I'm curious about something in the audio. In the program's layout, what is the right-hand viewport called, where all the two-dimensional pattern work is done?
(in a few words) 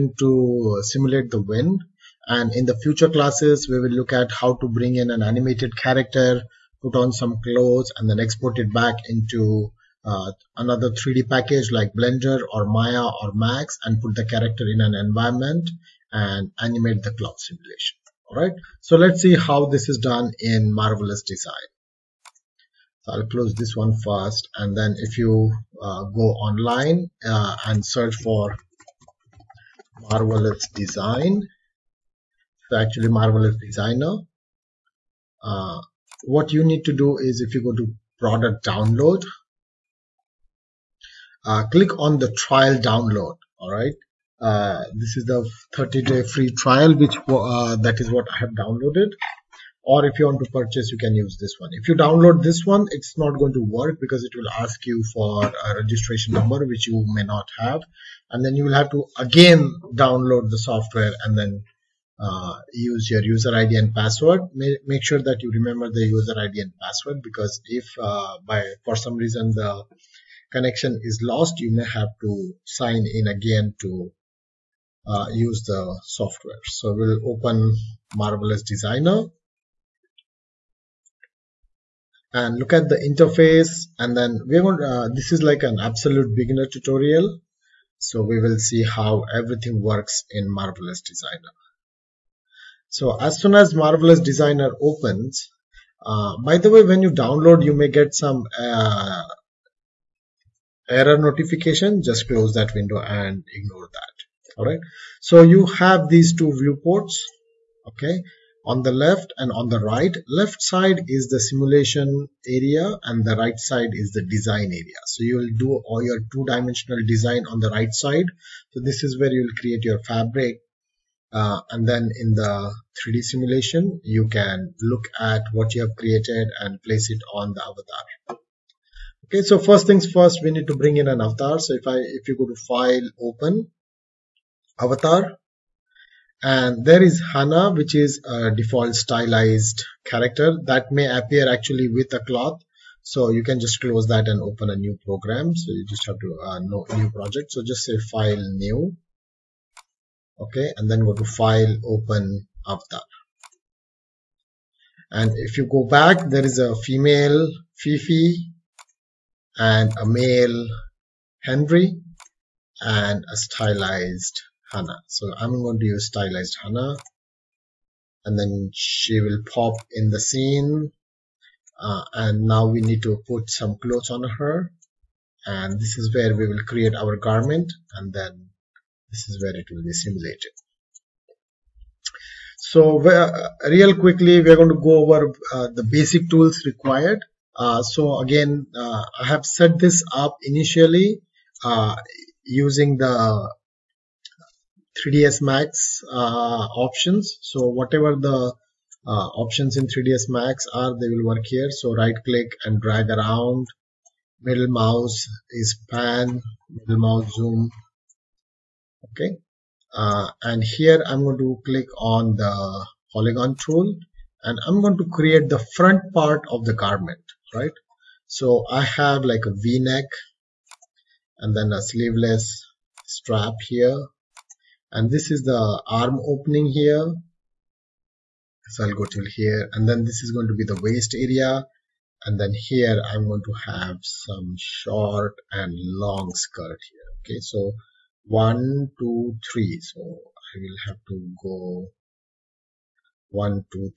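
design area.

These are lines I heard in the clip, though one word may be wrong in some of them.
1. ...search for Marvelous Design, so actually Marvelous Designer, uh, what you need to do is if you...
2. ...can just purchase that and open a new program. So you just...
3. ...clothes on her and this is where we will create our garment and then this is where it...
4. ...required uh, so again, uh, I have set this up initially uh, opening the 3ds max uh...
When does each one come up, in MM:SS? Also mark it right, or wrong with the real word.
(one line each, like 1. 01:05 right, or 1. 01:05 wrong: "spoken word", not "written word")
1. 00:27 right
2. 02:23 wrong: "close", not "purchase"
3. 02:53 right
4. 03:06 wrong: "using", not "opening".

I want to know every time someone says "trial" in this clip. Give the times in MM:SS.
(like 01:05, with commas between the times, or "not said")
00:42, 00:46.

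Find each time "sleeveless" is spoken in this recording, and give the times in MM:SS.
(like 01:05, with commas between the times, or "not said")
03:41.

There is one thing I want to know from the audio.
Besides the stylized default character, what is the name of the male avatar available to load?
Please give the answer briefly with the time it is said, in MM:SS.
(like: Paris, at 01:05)
Henry, at 02:41.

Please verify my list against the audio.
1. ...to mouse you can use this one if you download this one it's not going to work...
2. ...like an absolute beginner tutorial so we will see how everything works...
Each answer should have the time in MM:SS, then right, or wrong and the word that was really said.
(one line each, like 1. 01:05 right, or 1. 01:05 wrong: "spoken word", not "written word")
1. 00:50 wrong: "purchase", not "mouse"
2. 01:25 right.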